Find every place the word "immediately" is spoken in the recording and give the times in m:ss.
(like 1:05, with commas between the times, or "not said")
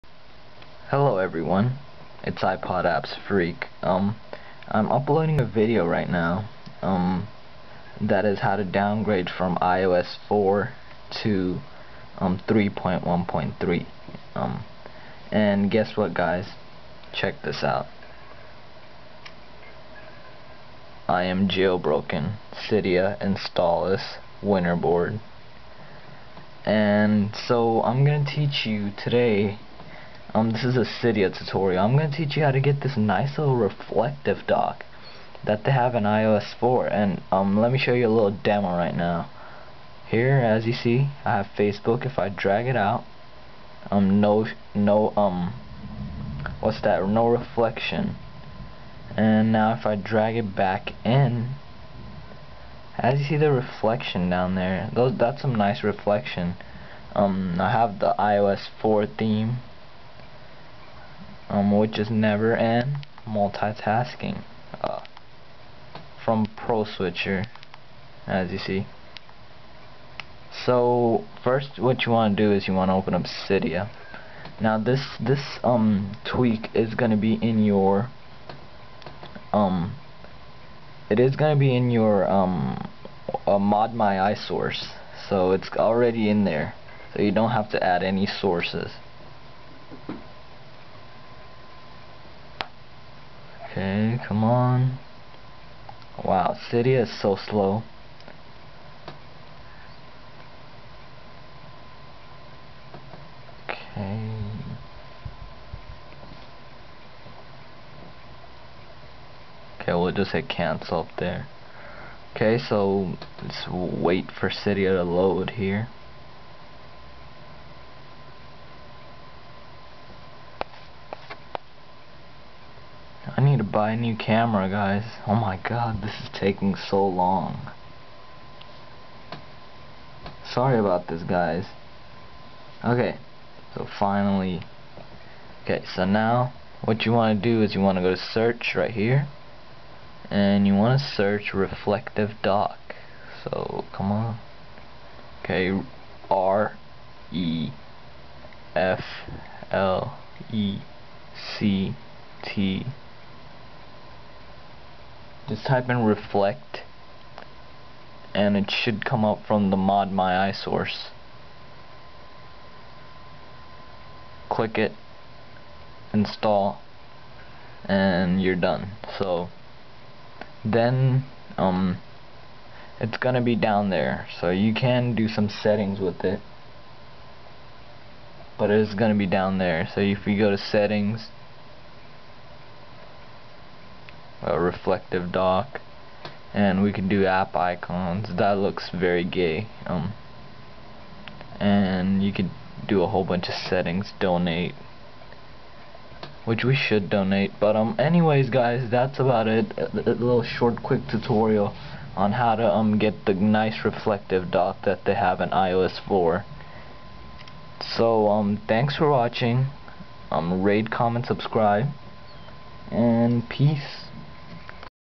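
not said.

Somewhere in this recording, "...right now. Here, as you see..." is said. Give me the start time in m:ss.
0:38.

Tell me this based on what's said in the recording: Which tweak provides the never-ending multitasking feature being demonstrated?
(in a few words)
Pro Switcher.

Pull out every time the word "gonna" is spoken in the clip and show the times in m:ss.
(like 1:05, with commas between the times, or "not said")
0:28, 1:16, 1:21, 2:53, 2:58.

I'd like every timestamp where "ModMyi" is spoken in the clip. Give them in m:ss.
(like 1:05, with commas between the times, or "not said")
1:23, 2:39.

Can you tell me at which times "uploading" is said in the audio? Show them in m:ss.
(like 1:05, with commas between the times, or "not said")
0:04.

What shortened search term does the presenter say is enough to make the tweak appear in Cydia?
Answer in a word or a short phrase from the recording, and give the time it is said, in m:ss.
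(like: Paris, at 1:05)
reflect, at 2:36.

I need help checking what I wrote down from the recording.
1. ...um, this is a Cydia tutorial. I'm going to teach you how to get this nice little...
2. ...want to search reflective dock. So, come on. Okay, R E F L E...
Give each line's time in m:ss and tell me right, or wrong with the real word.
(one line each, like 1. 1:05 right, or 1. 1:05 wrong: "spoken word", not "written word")
1. 0:30 right
2. 2:20 right.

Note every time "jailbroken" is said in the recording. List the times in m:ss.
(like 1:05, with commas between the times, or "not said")
0:21.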